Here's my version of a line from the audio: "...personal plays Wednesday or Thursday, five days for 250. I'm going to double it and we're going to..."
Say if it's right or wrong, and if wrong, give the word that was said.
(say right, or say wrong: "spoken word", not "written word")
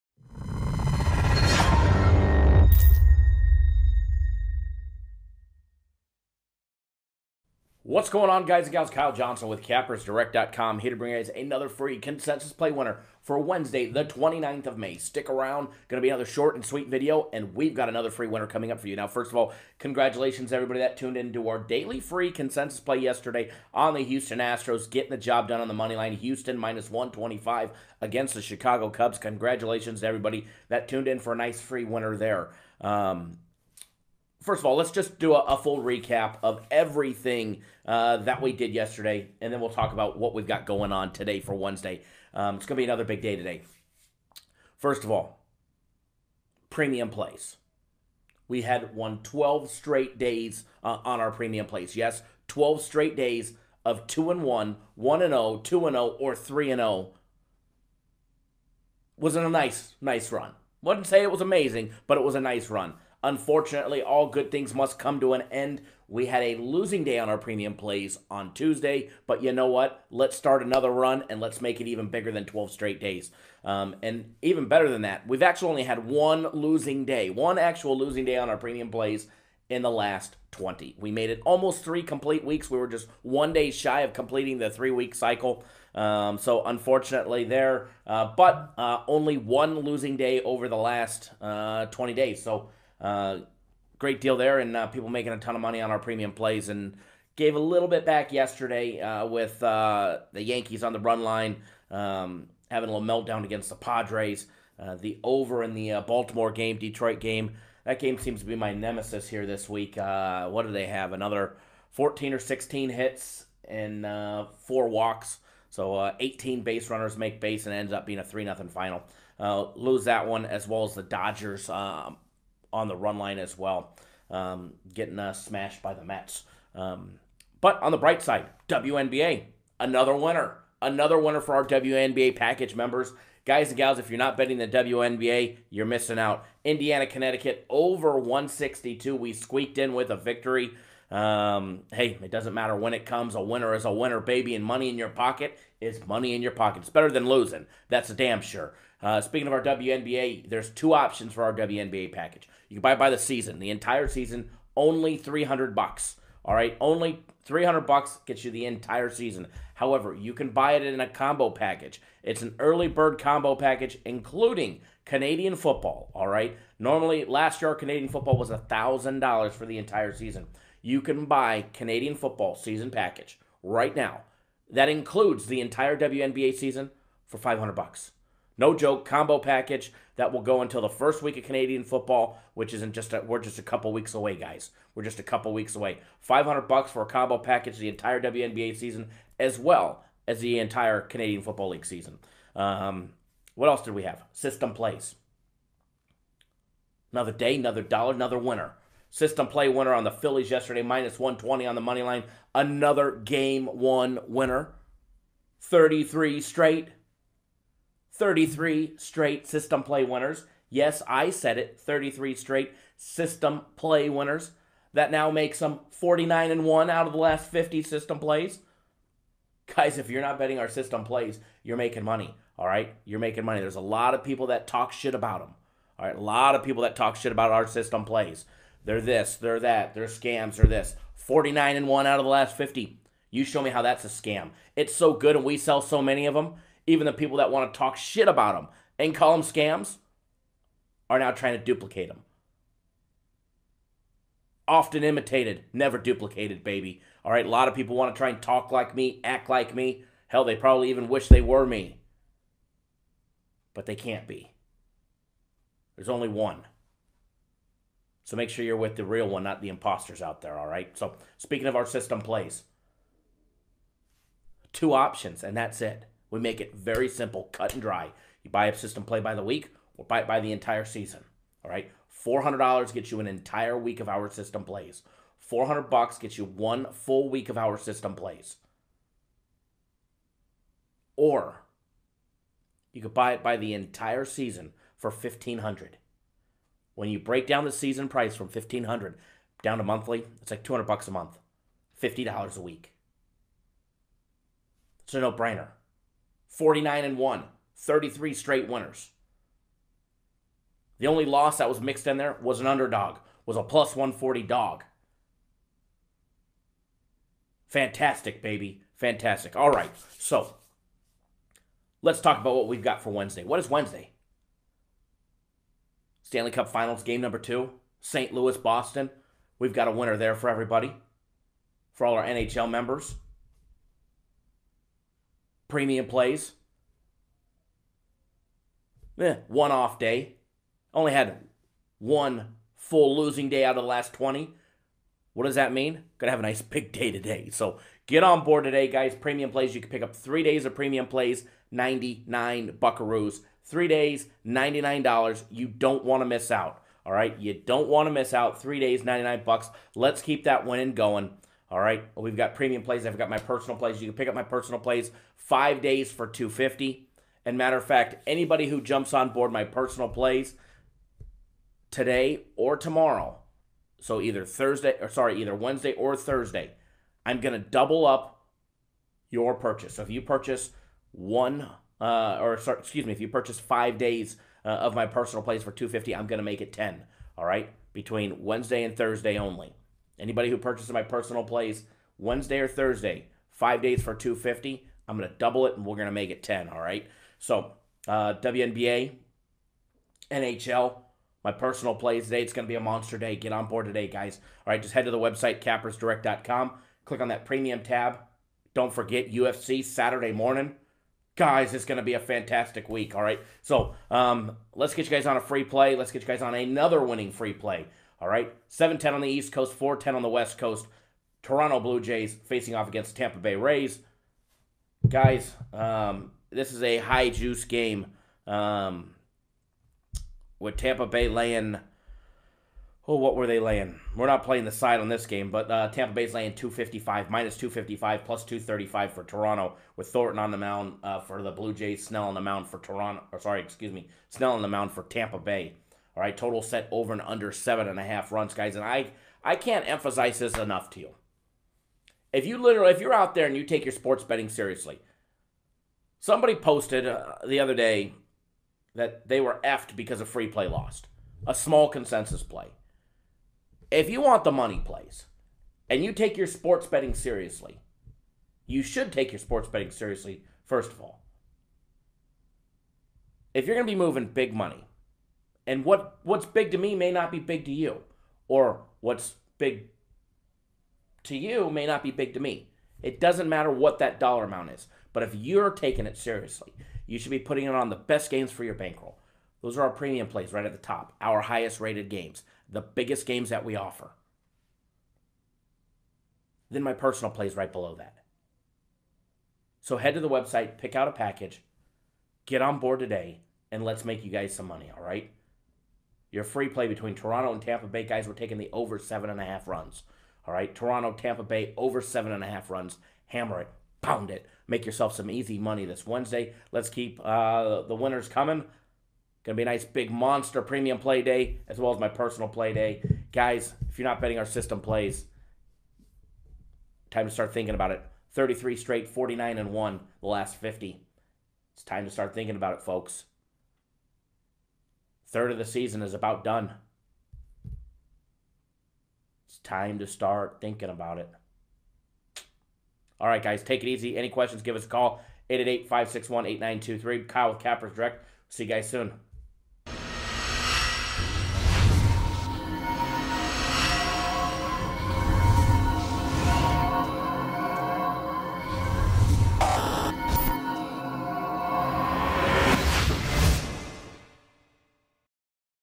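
right.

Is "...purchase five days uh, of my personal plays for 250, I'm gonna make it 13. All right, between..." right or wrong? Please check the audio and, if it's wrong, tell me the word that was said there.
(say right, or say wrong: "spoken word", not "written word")
wrong: "10", not "13".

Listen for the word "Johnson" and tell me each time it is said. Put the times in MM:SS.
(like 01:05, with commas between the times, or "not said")
00:09.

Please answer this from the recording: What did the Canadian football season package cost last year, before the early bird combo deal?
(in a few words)
$1000.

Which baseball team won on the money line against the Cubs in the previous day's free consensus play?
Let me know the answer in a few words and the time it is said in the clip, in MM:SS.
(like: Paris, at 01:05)
Houston Astros, at 00:24.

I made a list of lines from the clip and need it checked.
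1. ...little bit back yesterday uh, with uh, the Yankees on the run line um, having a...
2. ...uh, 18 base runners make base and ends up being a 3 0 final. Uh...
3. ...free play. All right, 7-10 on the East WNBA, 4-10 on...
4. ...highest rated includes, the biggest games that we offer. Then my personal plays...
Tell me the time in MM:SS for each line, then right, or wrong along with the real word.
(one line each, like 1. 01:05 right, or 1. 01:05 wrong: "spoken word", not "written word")
1. 01:37 right
2. 01:55 right
3. 06:47 wrong: "Coast", not "WNBA"
4. 08:01 wrong: "games", not "includes".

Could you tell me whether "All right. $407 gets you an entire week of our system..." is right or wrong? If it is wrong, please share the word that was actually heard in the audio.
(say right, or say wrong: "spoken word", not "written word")
wrong: "400", not "407".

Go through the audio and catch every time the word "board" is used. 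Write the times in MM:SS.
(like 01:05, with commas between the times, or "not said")
05:38, 05:59, 06:33, 08:12.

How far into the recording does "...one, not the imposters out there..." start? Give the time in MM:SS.
04:19.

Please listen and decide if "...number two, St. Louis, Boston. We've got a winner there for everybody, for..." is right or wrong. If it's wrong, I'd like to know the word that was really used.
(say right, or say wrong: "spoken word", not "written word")
right.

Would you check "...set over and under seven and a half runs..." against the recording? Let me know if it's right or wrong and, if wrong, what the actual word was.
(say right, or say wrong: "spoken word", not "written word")
right.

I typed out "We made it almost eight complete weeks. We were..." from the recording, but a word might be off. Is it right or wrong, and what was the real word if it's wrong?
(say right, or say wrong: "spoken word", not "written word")
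wrong: "three", not "eight".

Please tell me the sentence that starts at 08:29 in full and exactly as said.
Gonna be a nice big monster premium play day as well as my personal play day, guys.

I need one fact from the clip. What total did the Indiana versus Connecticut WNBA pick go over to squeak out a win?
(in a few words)
162.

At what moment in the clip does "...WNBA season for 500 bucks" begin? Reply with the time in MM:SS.
02:55.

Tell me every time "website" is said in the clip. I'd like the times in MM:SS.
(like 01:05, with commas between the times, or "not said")
06:35, 08:10.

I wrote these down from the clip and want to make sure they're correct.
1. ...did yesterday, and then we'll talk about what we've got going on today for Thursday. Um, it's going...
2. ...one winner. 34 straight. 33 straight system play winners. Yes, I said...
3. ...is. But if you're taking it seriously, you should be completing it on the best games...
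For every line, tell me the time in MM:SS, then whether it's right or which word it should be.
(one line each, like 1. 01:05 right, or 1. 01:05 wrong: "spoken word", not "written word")
1. 00:38 wrong: "Wednesday", not "Thursday"
2. 03:23 wrong: "33", not "34"
3. 07:54 wrong: "putting", not "completing".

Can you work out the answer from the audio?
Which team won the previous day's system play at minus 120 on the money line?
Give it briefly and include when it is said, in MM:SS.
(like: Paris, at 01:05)
Phillies, at 03:20.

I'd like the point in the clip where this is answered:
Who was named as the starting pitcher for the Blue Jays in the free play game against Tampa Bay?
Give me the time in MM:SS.
07:10.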